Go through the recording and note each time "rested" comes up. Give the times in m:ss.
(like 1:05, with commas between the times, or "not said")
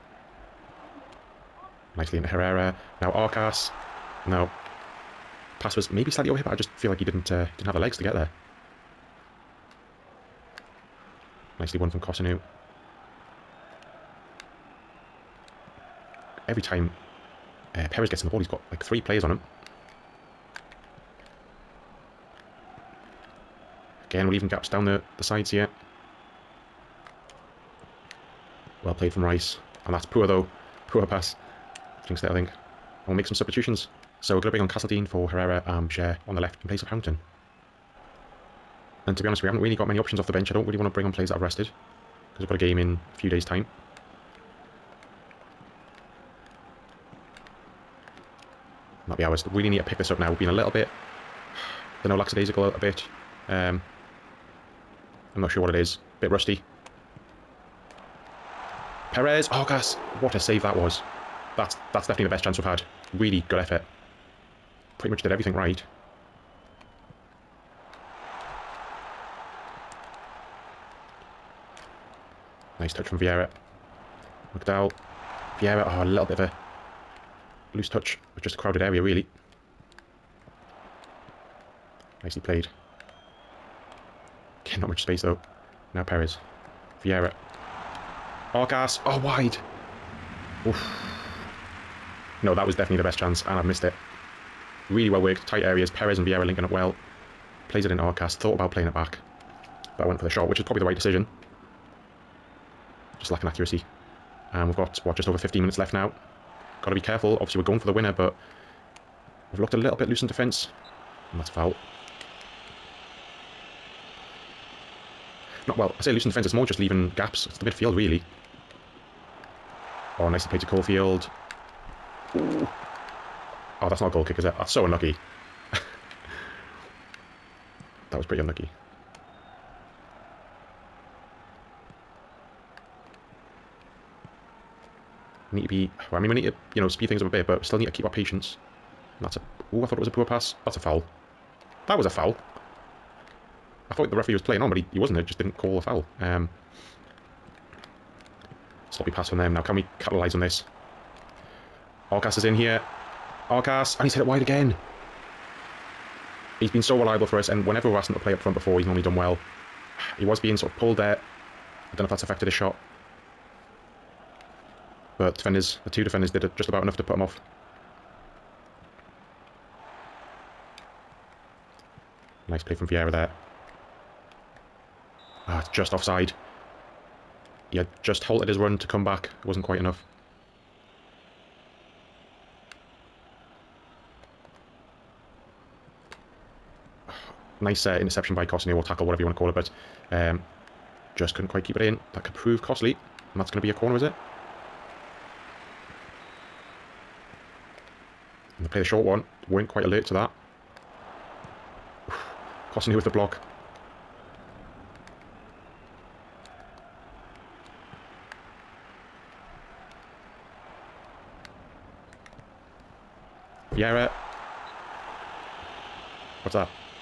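0:41.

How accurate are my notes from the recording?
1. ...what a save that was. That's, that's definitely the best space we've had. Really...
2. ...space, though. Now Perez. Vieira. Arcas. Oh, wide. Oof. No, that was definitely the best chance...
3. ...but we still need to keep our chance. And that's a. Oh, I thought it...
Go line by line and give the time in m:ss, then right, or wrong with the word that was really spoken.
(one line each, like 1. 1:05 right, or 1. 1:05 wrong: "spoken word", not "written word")
1. 1:00 wrong: "chance", not "space"
2. 1:25 right
3. 2:17 wrong: "patience", not "chance".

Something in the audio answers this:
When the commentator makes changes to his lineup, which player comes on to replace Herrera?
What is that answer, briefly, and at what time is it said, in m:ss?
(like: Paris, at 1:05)
Castledean, at 0:34.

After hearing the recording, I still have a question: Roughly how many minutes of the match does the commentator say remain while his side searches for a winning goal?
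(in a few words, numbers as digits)
15.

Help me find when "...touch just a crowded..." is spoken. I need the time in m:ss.
1:17.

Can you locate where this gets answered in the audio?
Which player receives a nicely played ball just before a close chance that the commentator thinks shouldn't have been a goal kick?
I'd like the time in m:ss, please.
2:00.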